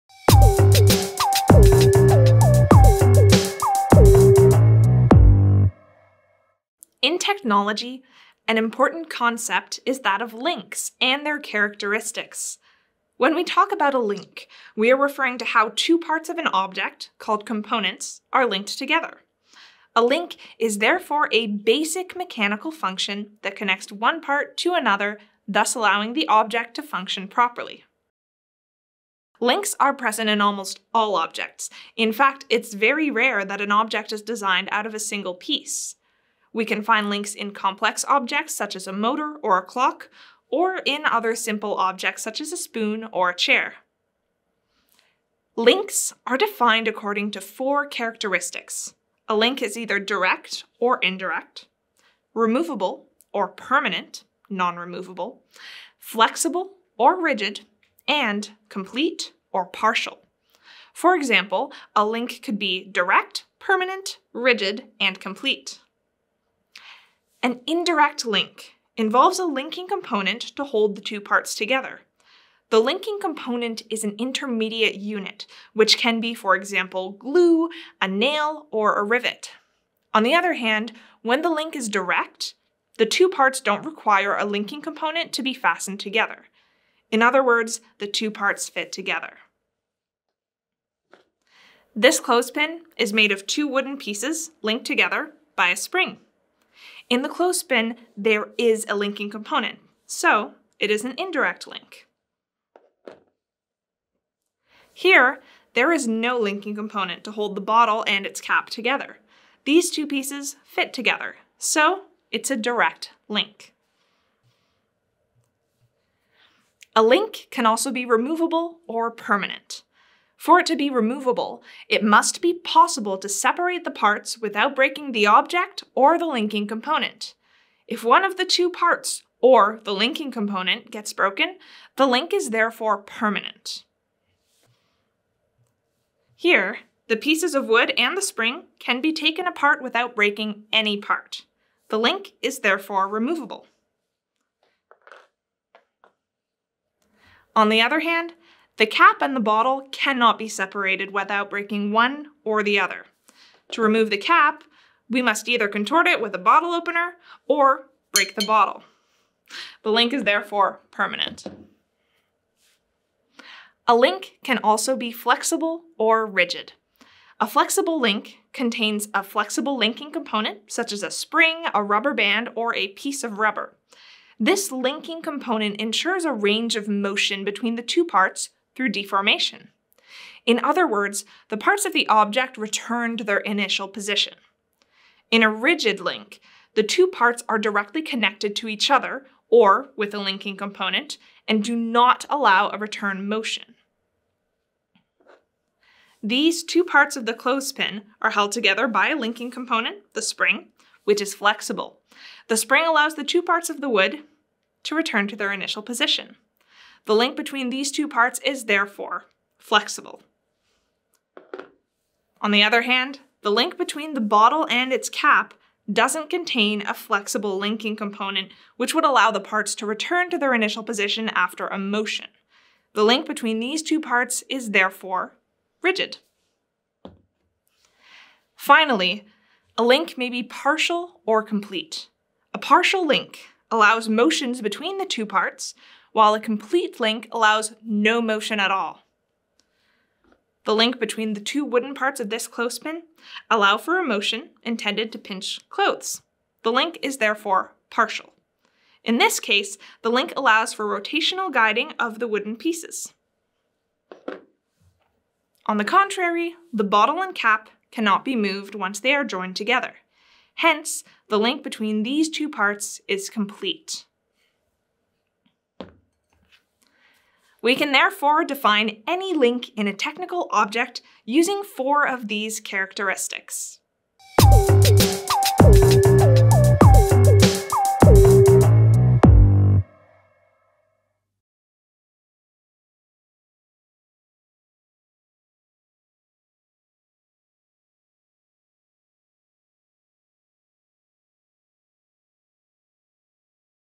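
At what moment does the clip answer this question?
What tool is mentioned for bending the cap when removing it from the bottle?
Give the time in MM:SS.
02:36.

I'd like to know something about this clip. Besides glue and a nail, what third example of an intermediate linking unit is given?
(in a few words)
a rivet.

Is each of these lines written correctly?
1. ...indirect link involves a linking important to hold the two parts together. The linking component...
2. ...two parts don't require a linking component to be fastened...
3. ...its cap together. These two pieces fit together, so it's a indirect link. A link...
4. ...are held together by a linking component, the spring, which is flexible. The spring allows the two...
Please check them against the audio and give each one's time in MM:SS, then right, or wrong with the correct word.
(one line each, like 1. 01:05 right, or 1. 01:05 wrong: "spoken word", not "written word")
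1. 01:07 wrong: "component", not "important"
2. 01:23 right
3. 01:48 wrong: "direct", not "indirect"
4. 03:18 right.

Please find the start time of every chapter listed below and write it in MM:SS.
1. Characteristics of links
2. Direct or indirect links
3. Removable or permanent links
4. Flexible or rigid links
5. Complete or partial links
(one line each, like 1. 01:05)
1. 00:45
2. 01:06
3. 01:56
4. 02:43
5. 03:48.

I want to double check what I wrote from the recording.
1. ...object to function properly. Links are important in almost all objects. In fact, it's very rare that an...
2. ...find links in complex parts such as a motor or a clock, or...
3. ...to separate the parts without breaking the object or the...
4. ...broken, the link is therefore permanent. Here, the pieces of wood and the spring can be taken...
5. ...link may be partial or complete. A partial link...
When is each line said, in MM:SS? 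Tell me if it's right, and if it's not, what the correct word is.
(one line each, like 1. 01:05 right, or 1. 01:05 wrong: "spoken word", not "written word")
1. 00:26 wrong: "present", not "important"
2. 00:36 wrong: "objects", not "parts"
3. 02:03 right
4. 02:11 right
5. 03:49 right.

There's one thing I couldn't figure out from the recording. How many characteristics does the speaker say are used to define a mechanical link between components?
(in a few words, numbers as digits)
4.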